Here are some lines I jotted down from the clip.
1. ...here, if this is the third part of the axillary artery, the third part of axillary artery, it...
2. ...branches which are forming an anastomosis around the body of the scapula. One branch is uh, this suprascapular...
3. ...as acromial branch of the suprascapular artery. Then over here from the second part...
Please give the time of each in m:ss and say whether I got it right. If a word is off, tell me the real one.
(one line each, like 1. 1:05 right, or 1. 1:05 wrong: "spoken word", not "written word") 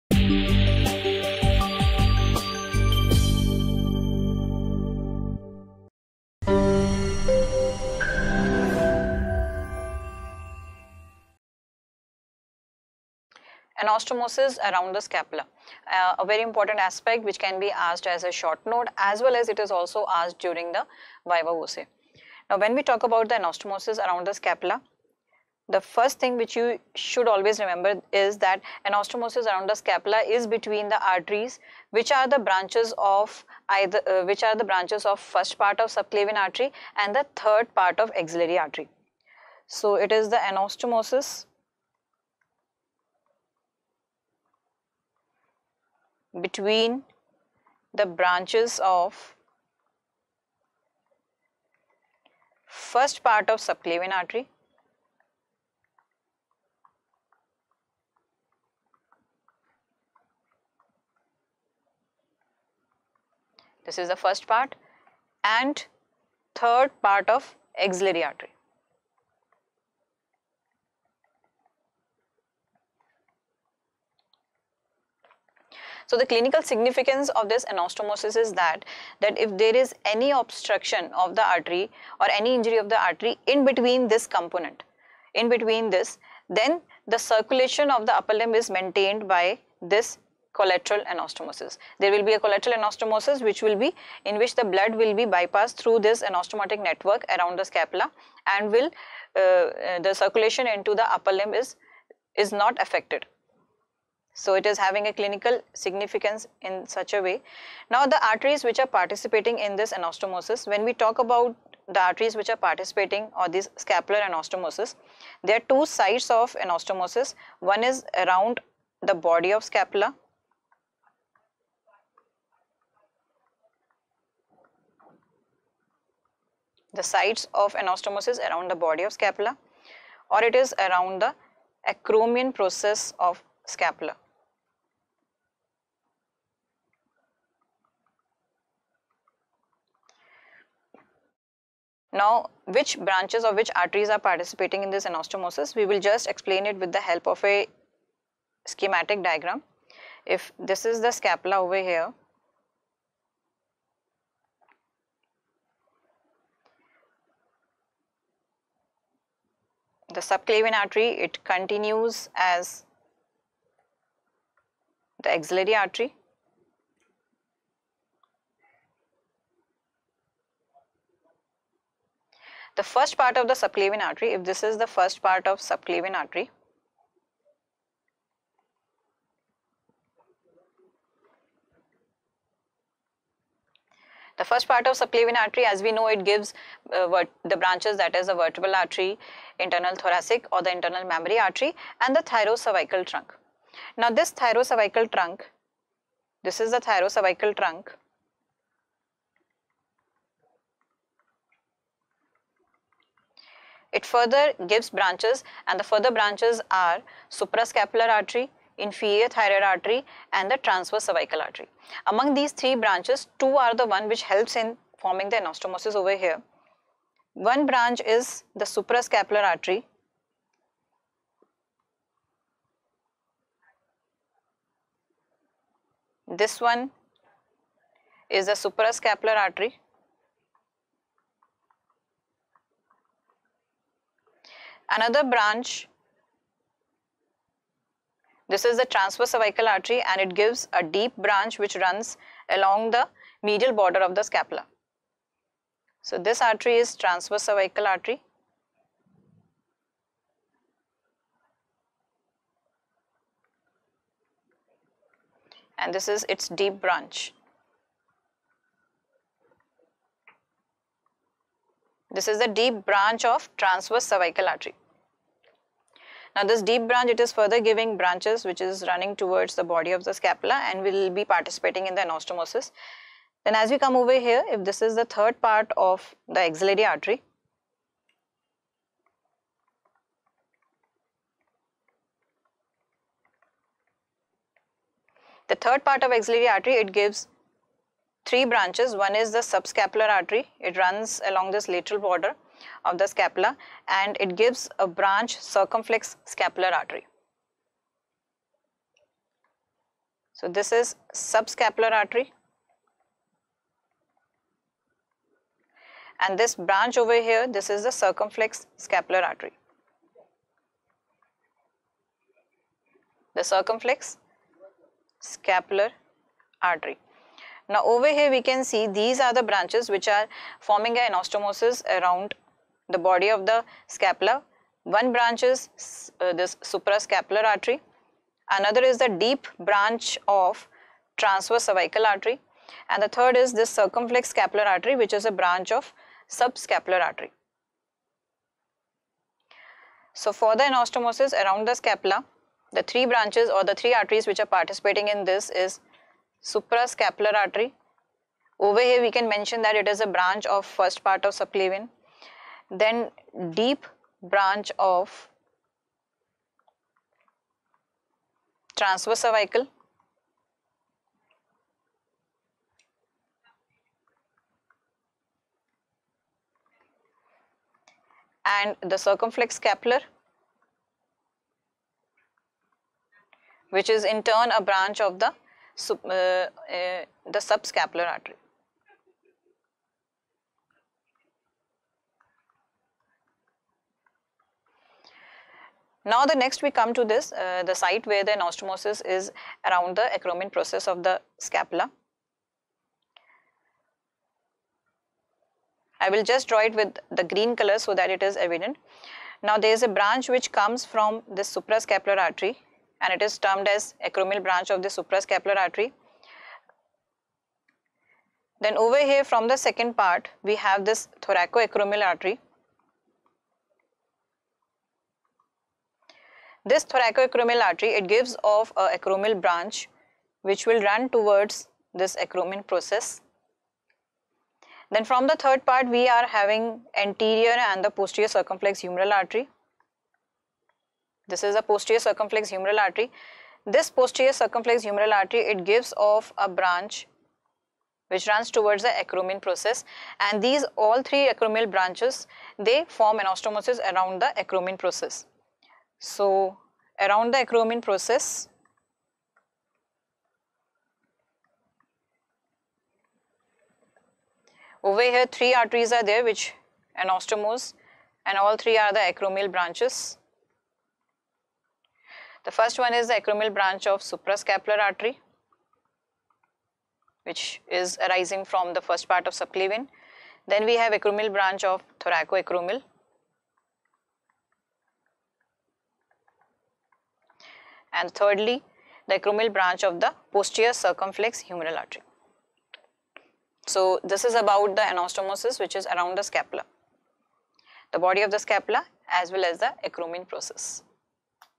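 1. 4:34 right
2. 5:19 right
3. 6:43 right.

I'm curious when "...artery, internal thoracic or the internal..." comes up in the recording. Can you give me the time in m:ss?
3:08.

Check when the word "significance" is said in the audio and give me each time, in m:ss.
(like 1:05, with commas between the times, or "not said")
1:16, 1:45.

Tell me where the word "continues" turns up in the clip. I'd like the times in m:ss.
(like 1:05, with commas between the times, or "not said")
2:41.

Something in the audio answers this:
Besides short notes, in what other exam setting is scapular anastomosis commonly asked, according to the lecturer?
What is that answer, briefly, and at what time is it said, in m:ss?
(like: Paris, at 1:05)
viva voce, at 0:21.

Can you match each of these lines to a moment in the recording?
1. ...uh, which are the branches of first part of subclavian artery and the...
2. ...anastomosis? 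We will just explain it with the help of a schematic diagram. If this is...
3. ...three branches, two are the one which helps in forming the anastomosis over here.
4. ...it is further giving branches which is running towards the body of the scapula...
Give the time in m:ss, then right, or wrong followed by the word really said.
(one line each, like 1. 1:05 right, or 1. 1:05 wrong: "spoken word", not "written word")
1. 0:34 right
2. 2:25 right
3. 3:32 right
4. 4:27 right.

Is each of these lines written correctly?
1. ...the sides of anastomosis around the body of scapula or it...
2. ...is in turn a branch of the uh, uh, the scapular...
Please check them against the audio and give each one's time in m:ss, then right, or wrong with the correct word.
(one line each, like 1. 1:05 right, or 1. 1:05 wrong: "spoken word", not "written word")
1. 2:06 wrong: "sites", not "sides"
2. 6:13 wrong: "subscapular", not "scapular".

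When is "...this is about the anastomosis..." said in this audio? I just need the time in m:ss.
8:04.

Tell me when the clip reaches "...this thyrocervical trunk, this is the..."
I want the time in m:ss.
3:14.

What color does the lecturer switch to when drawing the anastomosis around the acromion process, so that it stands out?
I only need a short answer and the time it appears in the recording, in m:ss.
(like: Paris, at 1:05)
green, at 6:37.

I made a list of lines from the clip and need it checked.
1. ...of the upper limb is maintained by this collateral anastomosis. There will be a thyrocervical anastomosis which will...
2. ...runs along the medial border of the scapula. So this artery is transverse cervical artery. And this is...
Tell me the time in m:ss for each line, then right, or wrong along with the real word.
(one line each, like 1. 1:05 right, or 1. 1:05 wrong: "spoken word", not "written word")
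1. 1:27 wrong: "collateral", not "thyrocervical"
2. 4:01 right.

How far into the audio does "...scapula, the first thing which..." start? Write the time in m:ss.
0:24.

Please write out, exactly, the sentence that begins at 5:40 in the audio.
So for the anastomosis around the scapula, the three branches or the three arteries which are participating in this is suprascapular artery.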